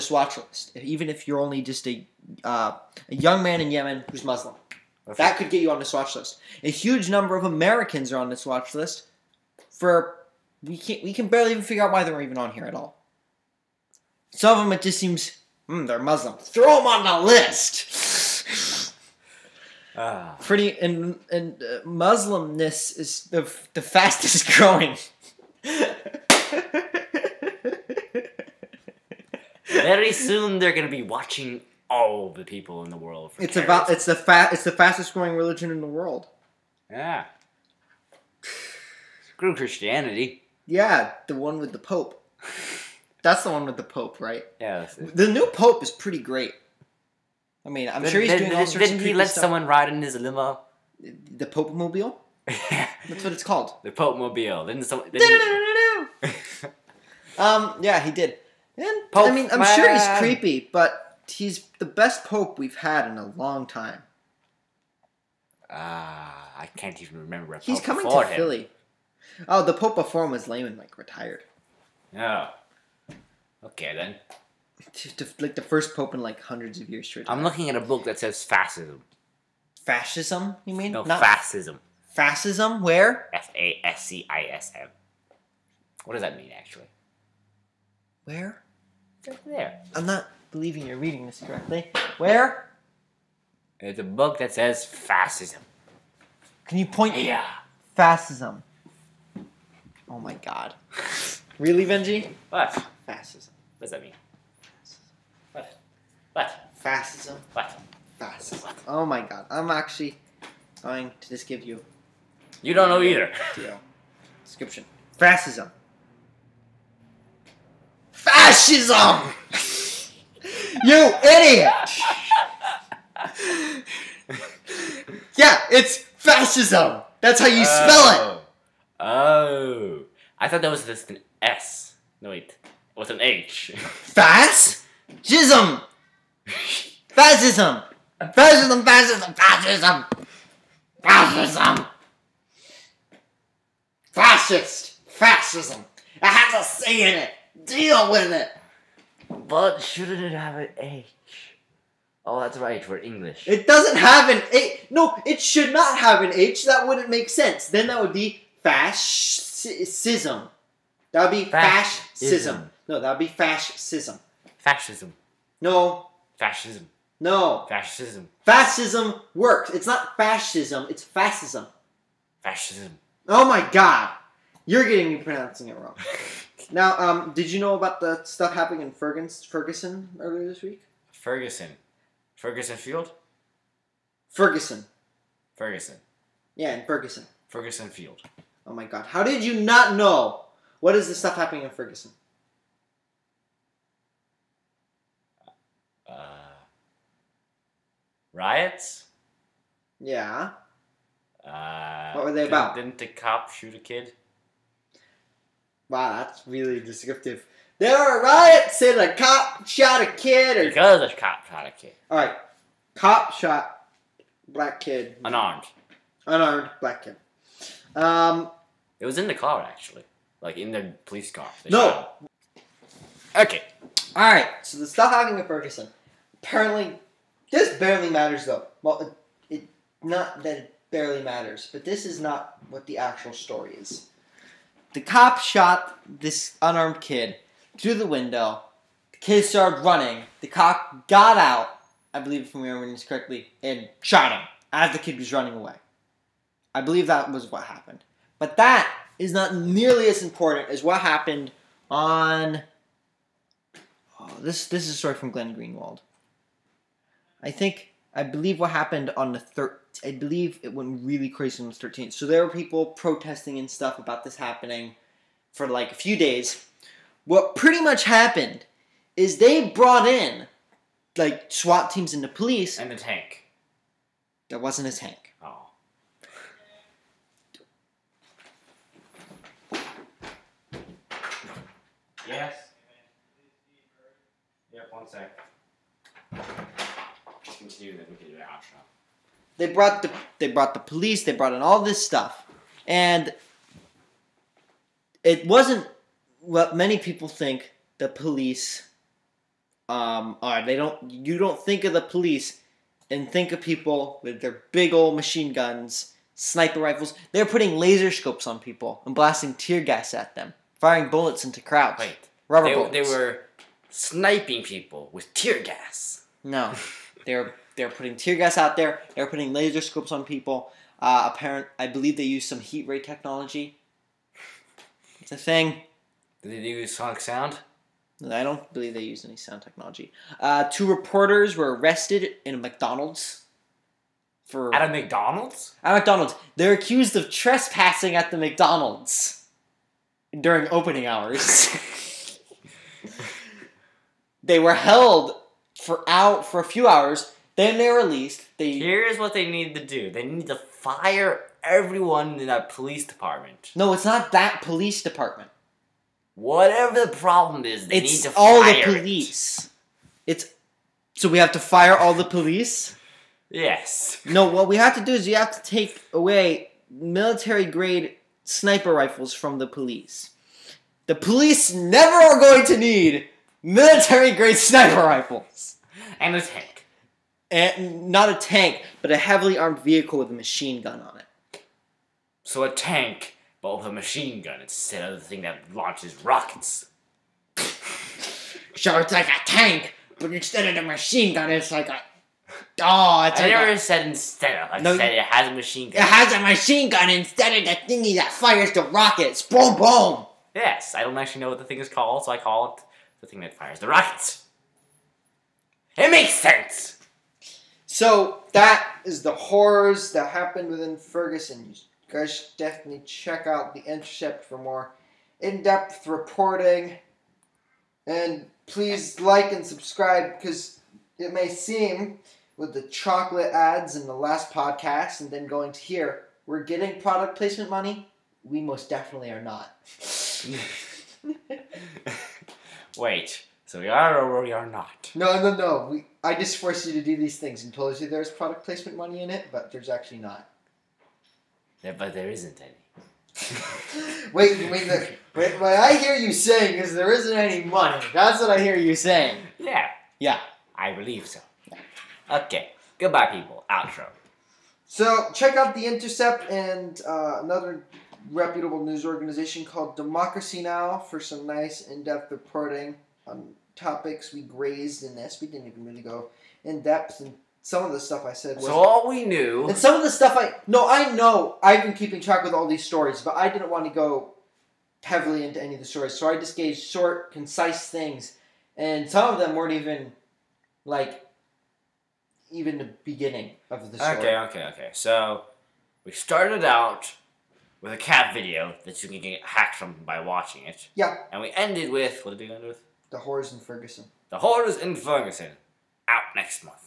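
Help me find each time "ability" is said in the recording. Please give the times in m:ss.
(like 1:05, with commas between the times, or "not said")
not said.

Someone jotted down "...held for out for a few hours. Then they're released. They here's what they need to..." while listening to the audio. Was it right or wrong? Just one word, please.
right.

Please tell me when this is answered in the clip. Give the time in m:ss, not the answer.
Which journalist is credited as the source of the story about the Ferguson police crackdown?
4:15.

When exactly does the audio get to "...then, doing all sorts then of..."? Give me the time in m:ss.
0:48.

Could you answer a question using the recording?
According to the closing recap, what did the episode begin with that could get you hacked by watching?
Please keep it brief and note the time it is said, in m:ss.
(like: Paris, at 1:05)
A cat video, at 8:07.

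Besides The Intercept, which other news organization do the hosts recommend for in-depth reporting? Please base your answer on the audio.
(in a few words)
Democracy Now!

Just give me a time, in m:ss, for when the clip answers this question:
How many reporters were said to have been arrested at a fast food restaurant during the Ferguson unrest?
5:30.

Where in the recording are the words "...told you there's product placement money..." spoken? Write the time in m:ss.
7:17.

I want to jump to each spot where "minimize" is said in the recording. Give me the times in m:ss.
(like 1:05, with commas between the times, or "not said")
not said.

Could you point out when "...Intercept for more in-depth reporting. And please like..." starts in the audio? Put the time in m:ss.
6:53.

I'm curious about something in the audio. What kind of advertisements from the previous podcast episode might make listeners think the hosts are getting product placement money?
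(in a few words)
Chocolate ads.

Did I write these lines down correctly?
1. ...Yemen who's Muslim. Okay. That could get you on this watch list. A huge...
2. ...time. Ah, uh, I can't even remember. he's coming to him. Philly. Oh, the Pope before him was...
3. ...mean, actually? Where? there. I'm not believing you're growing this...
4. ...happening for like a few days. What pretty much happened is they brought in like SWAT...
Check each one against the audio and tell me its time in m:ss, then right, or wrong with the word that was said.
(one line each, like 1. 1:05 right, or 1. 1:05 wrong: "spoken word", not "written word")
1. 0:03 right
2. 1:03 right
3. 1:26 wrong: "reading", not "growing"
4. 4:24 right.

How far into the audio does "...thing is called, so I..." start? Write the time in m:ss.
6:41.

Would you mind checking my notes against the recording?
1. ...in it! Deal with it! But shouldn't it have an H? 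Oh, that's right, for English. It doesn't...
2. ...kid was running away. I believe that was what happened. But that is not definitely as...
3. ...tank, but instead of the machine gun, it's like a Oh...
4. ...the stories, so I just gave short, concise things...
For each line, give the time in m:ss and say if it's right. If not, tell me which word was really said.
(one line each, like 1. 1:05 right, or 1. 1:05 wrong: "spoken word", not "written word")
1. 2:27 right
2. 4:04 wrong: "nearly", not "definitely"
3. 6:29 right
4. 7:55 right.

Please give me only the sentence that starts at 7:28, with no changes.
That's what I hear you saying.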